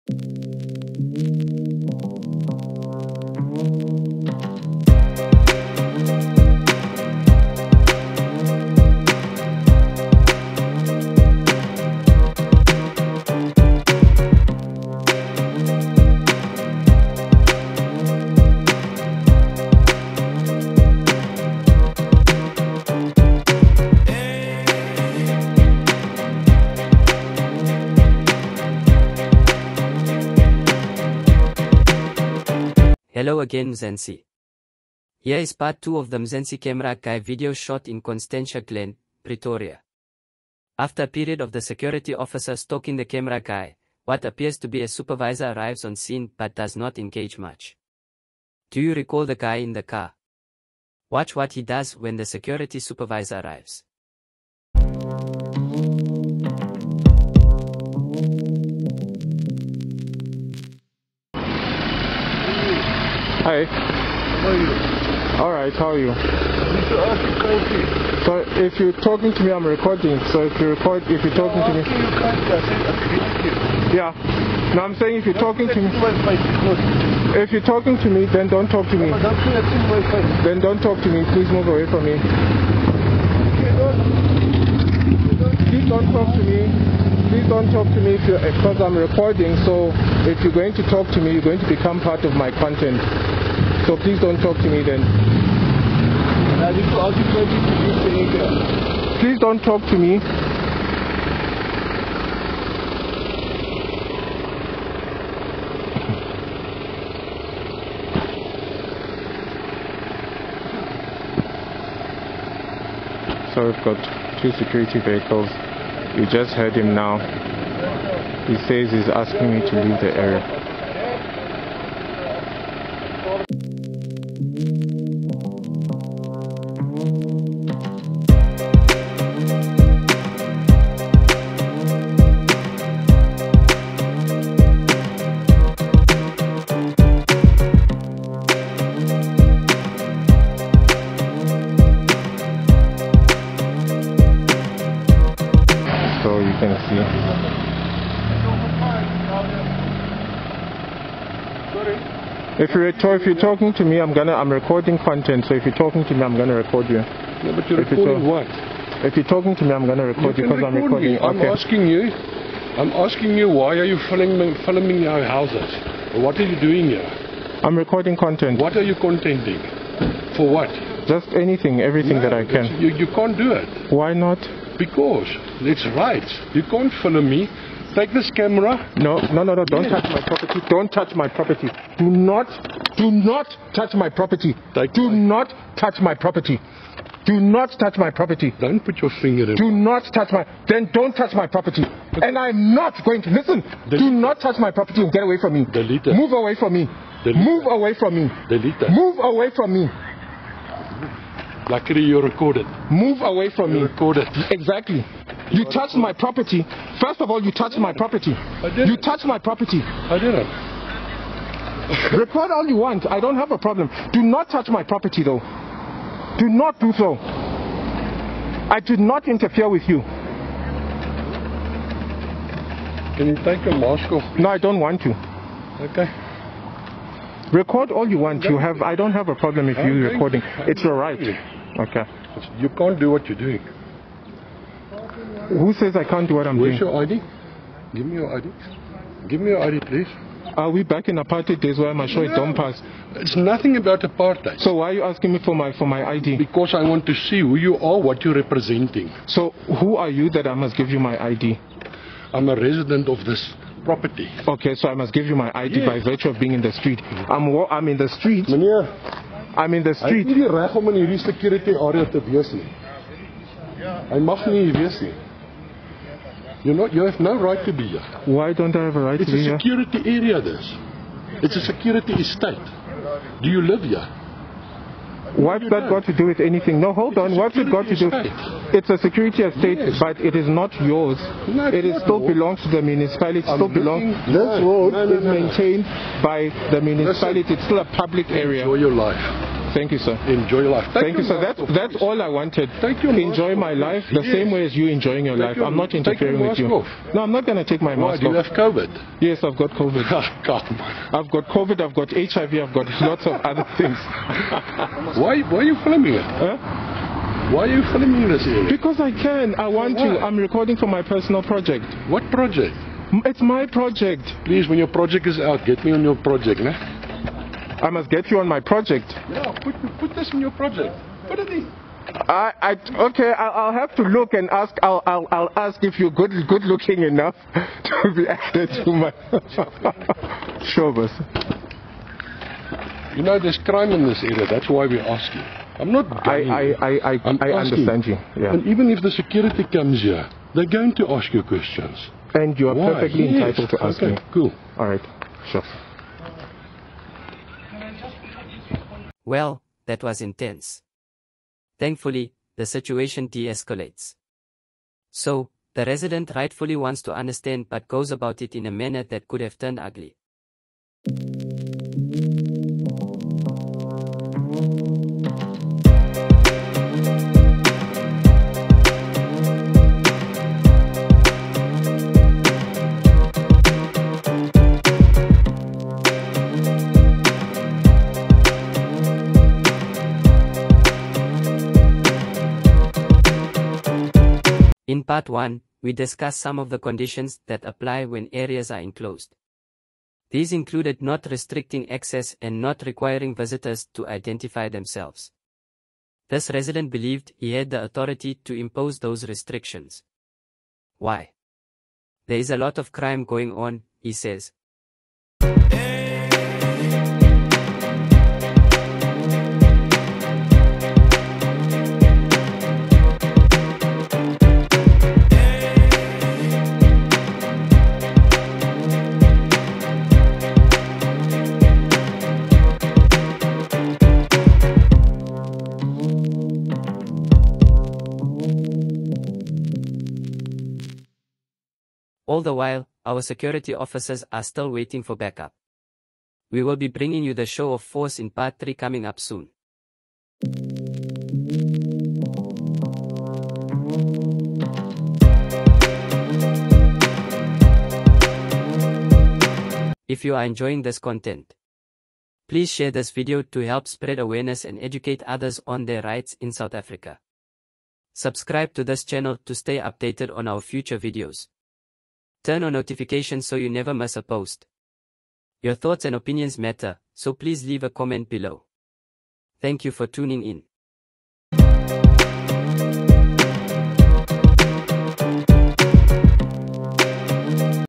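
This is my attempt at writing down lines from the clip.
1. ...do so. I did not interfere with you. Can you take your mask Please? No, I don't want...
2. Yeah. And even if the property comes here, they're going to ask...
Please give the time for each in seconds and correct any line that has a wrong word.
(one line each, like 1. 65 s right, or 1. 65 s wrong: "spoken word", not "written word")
1. 216 s right
2. 338 s wrong: "security", not "property".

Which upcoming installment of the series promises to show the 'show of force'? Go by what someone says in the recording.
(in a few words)
Part 3.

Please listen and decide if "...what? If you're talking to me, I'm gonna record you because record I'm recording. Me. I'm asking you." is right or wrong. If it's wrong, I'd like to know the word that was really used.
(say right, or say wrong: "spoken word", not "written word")
right.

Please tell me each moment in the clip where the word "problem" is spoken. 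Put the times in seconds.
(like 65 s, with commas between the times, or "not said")
213 s, 229 s.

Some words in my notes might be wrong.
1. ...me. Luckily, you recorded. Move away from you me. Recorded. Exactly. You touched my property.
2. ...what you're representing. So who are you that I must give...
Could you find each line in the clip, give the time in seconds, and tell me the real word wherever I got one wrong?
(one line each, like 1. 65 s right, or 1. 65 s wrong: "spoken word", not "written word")
1. 199 s right
2. 248 s right.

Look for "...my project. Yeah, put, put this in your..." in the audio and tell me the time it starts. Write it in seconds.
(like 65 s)
318 s.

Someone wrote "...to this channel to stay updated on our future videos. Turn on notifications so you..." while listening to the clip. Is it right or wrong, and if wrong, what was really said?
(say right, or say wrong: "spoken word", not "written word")
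right.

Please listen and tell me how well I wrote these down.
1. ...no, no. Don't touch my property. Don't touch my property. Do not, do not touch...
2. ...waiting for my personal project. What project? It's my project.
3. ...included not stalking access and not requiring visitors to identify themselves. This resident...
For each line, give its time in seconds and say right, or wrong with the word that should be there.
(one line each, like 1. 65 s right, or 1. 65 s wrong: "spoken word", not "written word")
1. 179 s right
2. 310 s wrong: "recording", not "waiting"
3. 390 s wrong: "restricting", not "stalking".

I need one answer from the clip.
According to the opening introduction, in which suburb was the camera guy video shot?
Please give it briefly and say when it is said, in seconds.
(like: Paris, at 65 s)
Constantia Glen, at 38 s.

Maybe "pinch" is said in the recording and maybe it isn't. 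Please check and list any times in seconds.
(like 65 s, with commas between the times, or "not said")
not said.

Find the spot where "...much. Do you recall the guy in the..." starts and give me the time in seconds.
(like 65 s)
47 s.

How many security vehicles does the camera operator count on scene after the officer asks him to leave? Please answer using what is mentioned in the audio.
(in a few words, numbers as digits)
2.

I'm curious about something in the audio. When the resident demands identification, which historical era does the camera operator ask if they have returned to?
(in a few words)
Apartheid days.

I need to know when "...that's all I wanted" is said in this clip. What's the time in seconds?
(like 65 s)
291 s.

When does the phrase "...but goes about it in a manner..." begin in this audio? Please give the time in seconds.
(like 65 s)
357 s.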